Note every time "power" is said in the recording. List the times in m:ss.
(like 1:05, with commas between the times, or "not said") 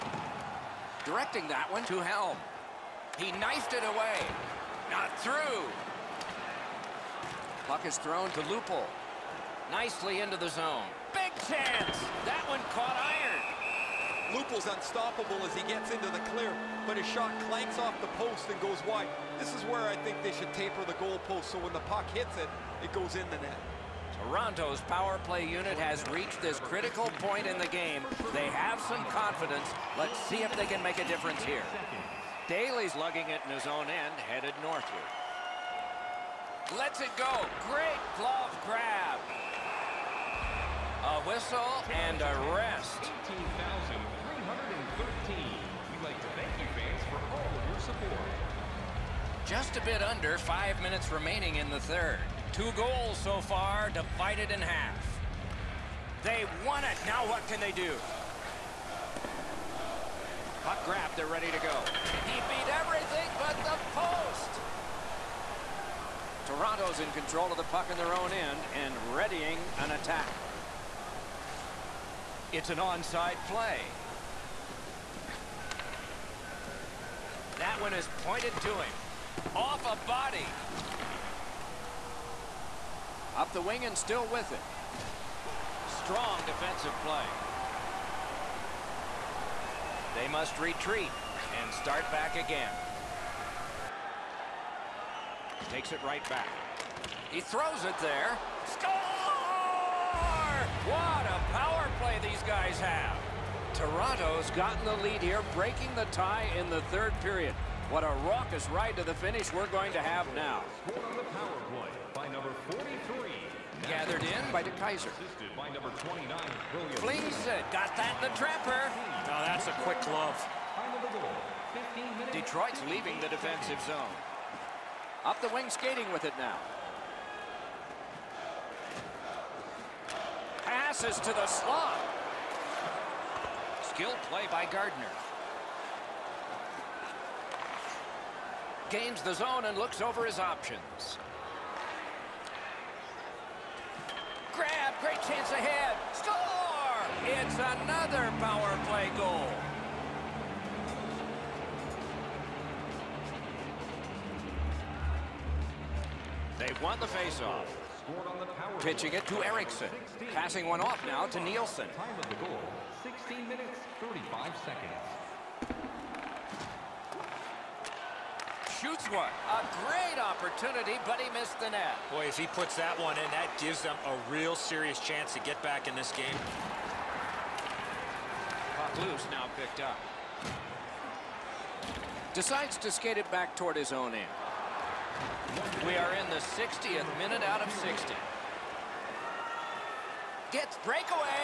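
0:24, 1:41, 2:28.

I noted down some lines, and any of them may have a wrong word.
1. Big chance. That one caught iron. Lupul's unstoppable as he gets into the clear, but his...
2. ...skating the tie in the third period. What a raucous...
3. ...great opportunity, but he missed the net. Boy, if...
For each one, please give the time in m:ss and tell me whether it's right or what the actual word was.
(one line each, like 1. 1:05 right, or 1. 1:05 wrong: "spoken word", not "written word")
1. 0:11 right
2. 1:45 wrong: "breaking", not "skating"
3. 2:49 right.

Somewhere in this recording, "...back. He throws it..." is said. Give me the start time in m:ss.
1:36.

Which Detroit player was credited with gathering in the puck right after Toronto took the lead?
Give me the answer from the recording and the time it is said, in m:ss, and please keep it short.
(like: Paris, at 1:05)
DeKeyser, at 1:54.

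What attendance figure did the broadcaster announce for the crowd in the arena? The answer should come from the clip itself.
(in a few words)
18,313.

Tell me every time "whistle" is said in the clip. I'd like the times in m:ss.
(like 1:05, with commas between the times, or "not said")
0:41.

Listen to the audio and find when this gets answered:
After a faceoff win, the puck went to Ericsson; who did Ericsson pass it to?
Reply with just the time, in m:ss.
2:41.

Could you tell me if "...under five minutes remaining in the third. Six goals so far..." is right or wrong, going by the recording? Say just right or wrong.
wrong.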